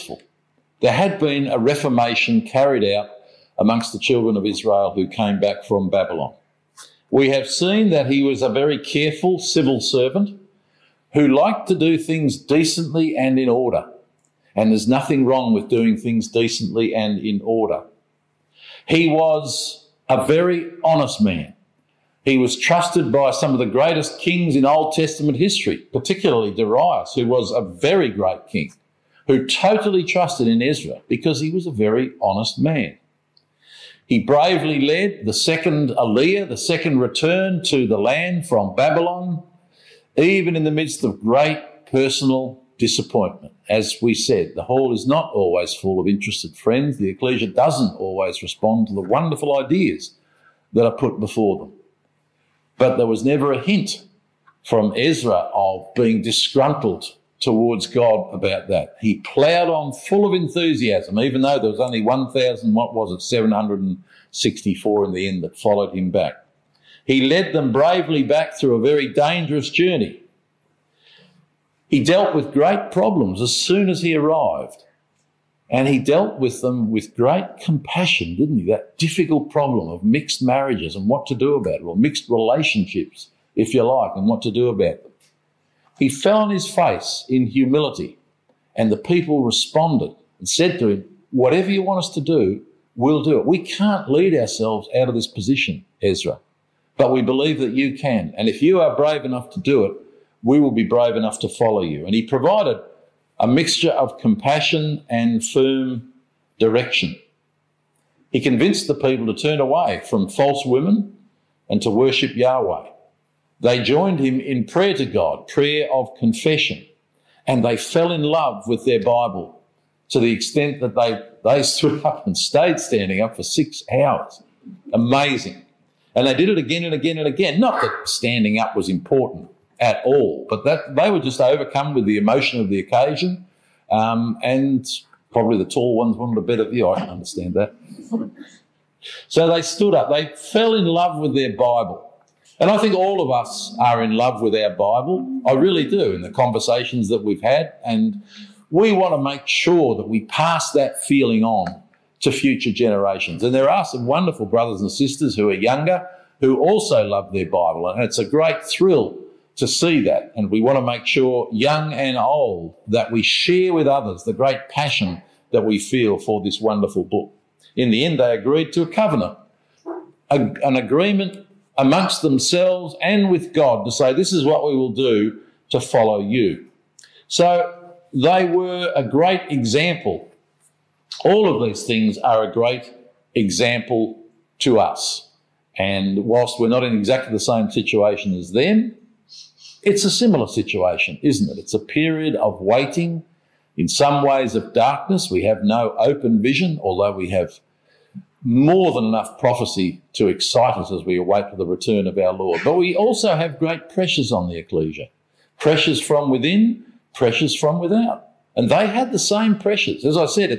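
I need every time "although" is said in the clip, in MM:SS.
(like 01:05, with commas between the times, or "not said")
03:16.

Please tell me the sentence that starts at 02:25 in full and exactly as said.
I really do in the conversations that we've had.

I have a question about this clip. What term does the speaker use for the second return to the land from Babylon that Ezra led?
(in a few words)
Aliyah.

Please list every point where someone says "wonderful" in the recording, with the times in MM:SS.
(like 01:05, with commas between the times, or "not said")
00:49, 02:34, 02:46.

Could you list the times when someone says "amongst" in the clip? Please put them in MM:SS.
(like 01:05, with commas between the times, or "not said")
00:03, 02:51.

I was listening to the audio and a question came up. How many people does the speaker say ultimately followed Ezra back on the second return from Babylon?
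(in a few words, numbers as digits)
1,764.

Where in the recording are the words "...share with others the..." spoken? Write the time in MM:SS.
02:43.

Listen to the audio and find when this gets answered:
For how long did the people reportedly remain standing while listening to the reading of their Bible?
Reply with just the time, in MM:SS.
02:03.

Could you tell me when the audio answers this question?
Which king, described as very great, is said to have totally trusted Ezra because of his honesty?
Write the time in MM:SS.
00:26.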